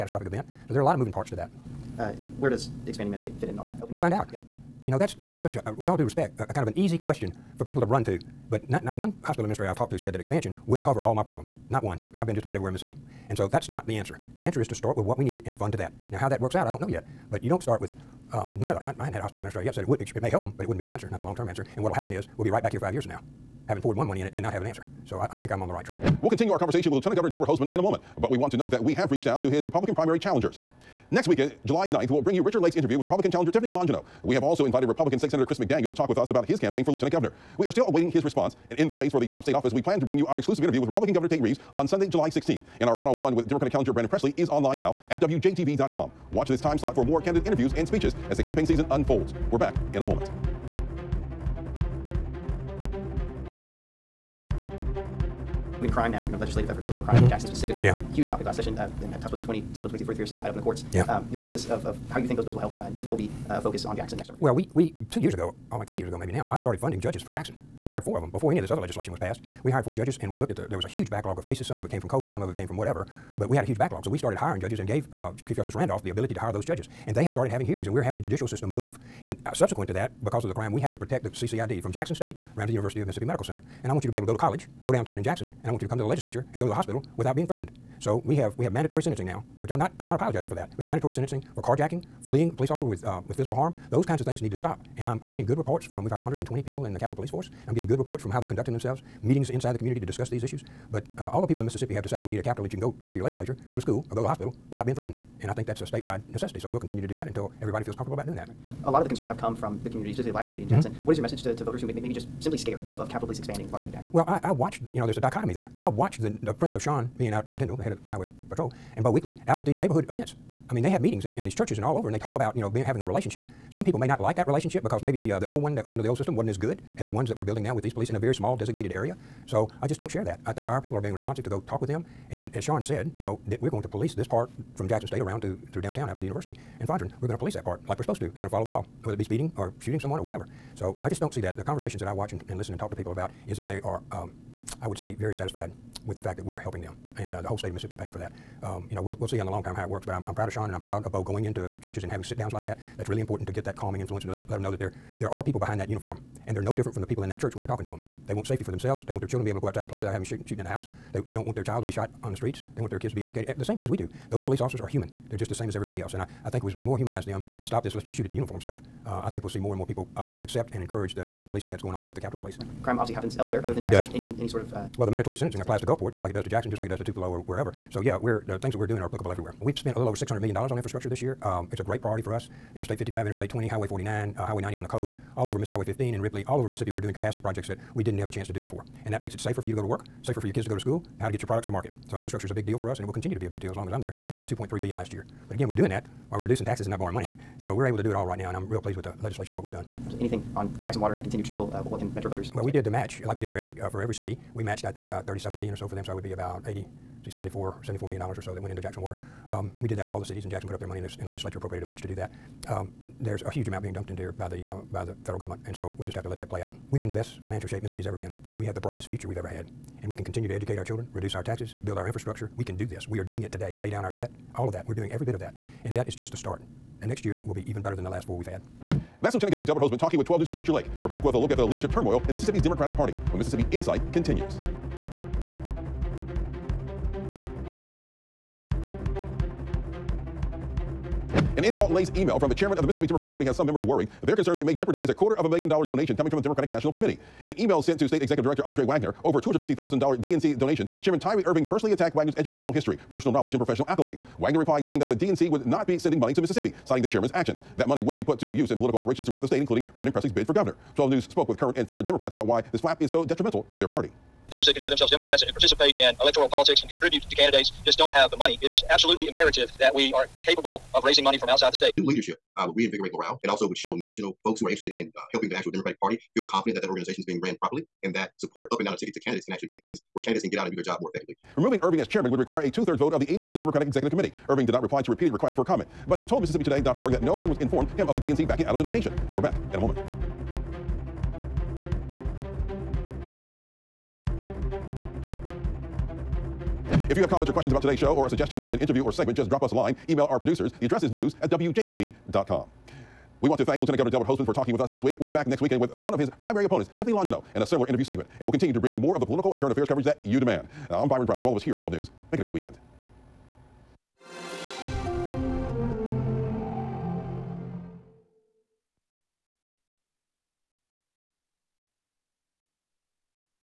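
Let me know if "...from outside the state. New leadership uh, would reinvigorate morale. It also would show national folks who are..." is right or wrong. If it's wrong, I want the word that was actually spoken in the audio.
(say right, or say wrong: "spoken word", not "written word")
right.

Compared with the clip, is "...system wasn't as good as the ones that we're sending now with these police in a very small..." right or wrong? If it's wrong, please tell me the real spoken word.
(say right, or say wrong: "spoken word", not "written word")
wrong: "building", not "sending".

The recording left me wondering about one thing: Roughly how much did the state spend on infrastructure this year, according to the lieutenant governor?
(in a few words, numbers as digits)
$600 million.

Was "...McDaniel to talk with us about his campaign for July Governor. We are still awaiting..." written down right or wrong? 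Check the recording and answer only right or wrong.
wrong.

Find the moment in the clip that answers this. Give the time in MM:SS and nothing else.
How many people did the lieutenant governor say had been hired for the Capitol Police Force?
01:36.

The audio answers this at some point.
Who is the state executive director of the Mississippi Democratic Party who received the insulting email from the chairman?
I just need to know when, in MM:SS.
04:08.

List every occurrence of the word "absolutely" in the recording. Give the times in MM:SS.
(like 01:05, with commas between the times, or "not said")
03:20, 04:28.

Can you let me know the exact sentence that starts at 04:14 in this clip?
Wagner replied saying that the DNC would not be sending money to Mississippi, citing the chairman's actions.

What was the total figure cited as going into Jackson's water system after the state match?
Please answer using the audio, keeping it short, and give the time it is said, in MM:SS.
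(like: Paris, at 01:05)
$74 million, at 03:27.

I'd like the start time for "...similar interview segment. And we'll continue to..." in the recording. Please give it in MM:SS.
05:07.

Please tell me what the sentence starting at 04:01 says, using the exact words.
An insult laced email from the chairman of the Mississippi Democratic Party has some members worried.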